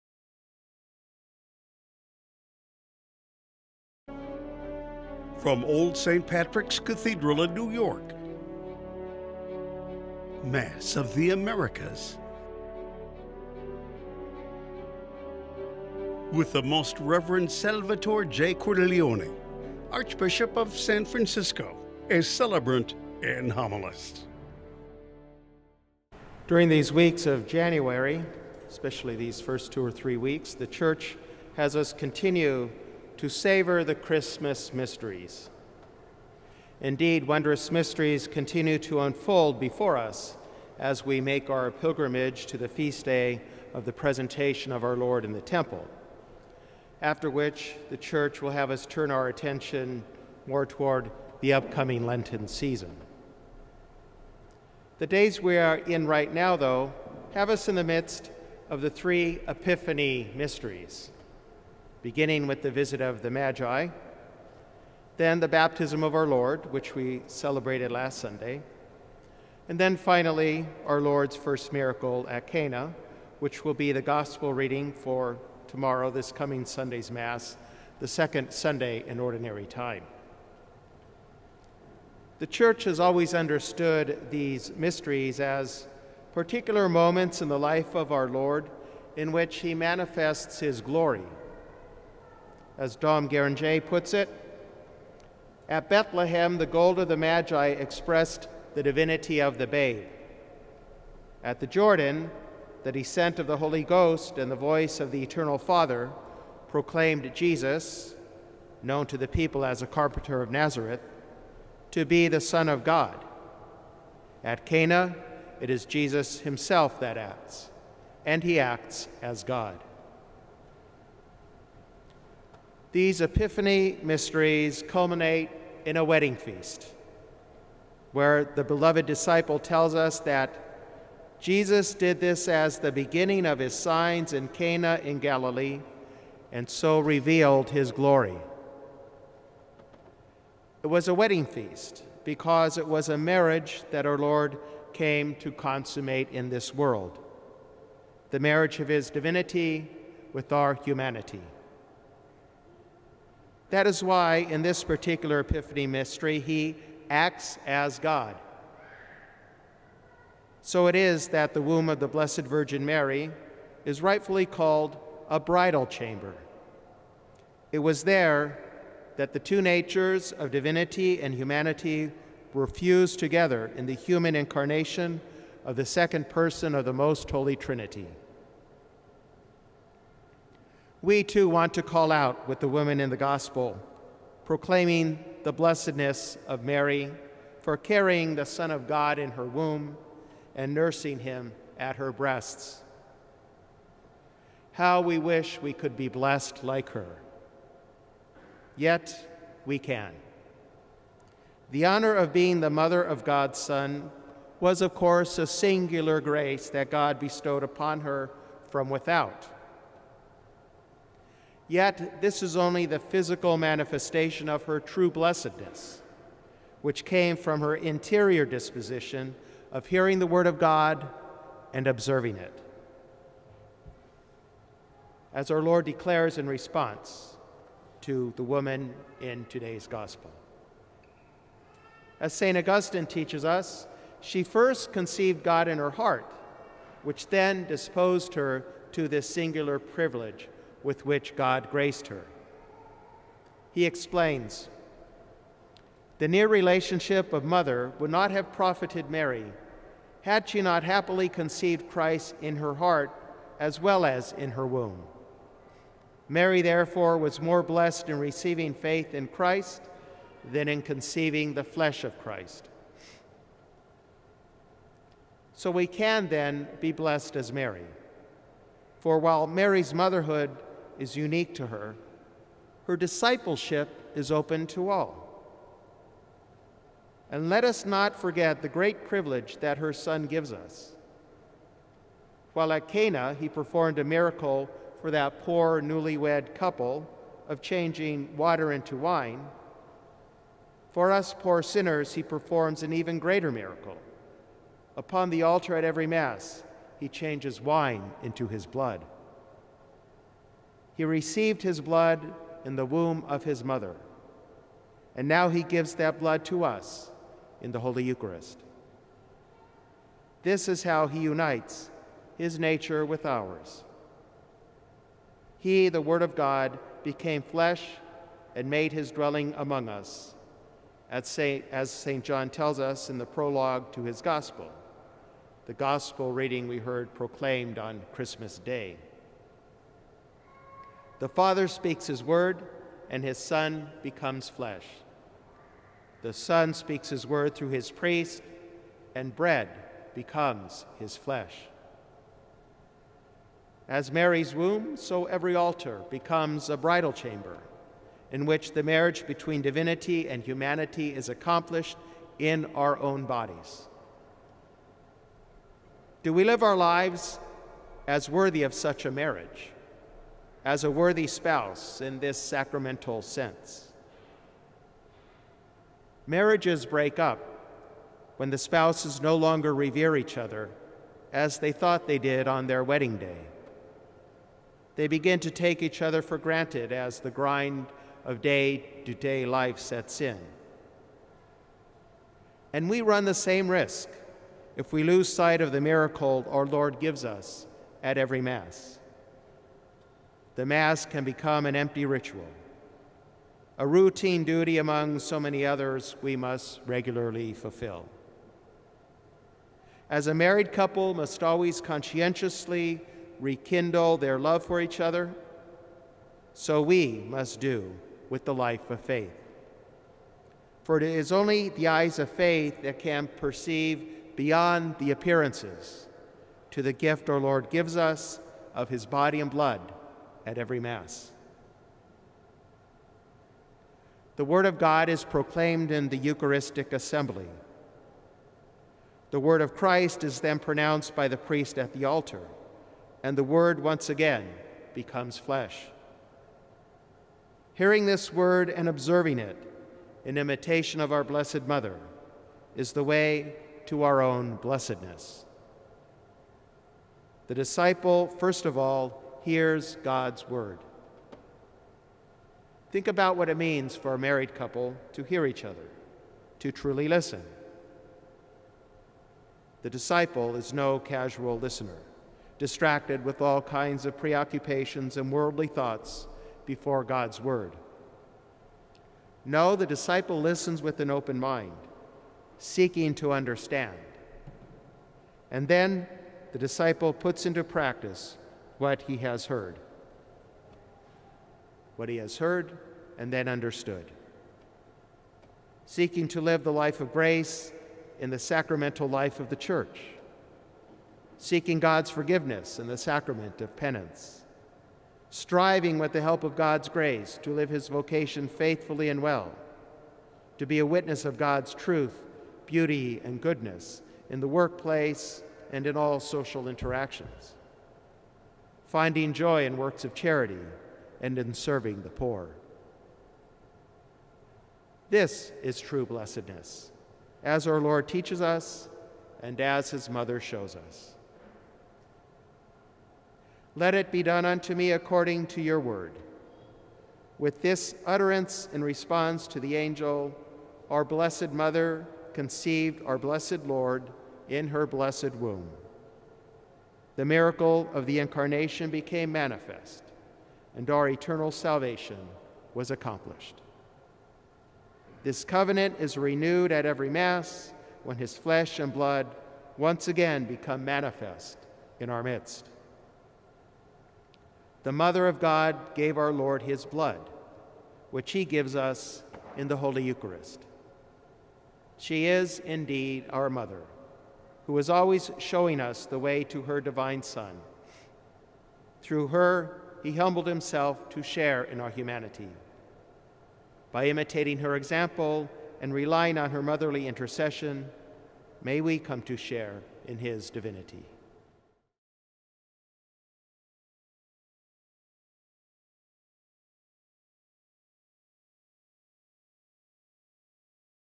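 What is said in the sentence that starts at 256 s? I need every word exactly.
Mary, therefore, was more blessed in receiving faith in Christ than in conceiving the flesh of Christ.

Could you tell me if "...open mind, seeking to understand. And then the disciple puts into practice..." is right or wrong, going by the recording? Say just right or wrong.
right.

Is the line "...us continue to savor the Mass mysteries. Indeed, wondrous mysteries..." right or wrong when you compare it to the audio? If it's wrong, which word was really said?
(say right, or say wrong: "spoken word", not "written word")
wrong: "Christmas", not "Mass".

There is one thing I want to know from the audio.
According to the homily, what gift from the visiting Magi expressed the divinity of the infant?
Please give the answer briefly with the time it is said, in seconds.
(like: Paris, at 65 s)
Gold, at 96 s.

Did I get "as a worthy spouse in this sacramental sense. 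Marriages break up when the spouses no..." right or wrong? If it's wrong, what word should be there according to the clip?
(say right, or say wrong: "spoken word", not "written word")
right.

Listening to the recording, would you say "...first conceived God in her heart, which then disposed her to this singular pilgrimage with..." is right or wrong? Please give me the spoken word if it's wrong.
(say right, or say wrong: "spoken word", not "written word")
wrong: "privilege", not "pilgrimage".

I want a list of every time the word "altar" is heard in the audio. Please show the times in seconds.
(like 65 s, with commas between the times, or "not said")
295 s, 345 s, 432 s.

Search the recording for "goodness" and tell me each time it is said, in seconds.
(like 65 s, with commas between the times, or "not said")
503 s.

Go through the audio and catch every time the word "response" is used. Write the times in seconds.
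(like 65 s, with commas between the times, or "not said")
226 s, 528 s.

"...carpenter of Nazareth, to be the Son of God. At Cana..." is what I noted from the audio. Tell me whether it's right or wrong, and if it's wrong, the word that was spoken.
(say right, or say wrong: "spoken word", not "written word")
right.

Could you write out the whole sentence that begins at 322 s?
John tells us in the prologue to his Gospel, the Gospel reading we heard proclaimed on Christmas Day.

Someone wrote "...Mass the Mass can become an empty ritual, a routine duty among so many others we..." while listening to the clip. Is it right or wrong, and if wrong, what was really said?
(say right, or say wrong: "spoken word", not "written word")
right.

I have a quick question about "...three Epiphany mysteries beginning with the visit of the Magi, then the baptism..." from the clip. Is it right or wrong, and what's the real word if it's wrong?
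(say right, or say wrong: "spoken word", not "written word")
right.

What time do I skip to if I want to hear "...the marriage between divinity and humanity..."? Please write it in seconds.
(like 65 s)
348 s.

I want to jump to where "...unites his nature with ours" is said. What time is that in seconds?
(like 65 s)
311 s.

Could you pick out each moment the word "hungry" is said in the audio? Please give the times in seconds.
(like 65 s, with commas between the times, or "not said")
not said.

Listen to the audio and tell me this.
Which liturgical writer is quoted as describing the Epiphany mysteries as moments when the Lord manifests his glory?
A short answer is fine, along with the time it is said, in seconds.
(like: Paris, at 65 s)
Dom Guéranger, at 92 s.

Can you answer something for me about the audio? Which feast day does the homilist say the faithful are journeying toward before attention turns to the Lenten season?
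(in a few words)
Presentation of our Lord.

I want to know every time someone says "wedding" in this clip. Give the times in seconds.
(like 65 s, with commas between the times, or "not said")
126 s, 141 s, 372 s.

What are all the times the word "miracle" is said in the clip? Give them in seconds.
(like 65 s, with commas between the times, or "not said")
71 s, 284 s, 293 s, 385 s, 537 s.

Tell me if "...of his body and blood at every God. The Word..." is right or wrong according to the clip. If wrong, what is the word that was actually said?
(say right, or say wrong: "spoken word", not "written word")
wrong: "Mass", not "God".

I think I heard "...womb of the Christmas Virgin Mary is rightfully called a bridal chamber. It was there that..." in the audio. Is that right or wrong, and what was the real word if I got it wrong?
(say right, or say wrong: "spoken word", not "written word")
wrong: "Blessed", not "Christmas".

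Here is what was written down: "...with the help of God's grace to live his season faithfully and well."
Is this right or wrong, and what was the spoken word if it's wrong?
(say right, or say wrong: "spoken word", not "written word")
wrong: "vocation", not "season".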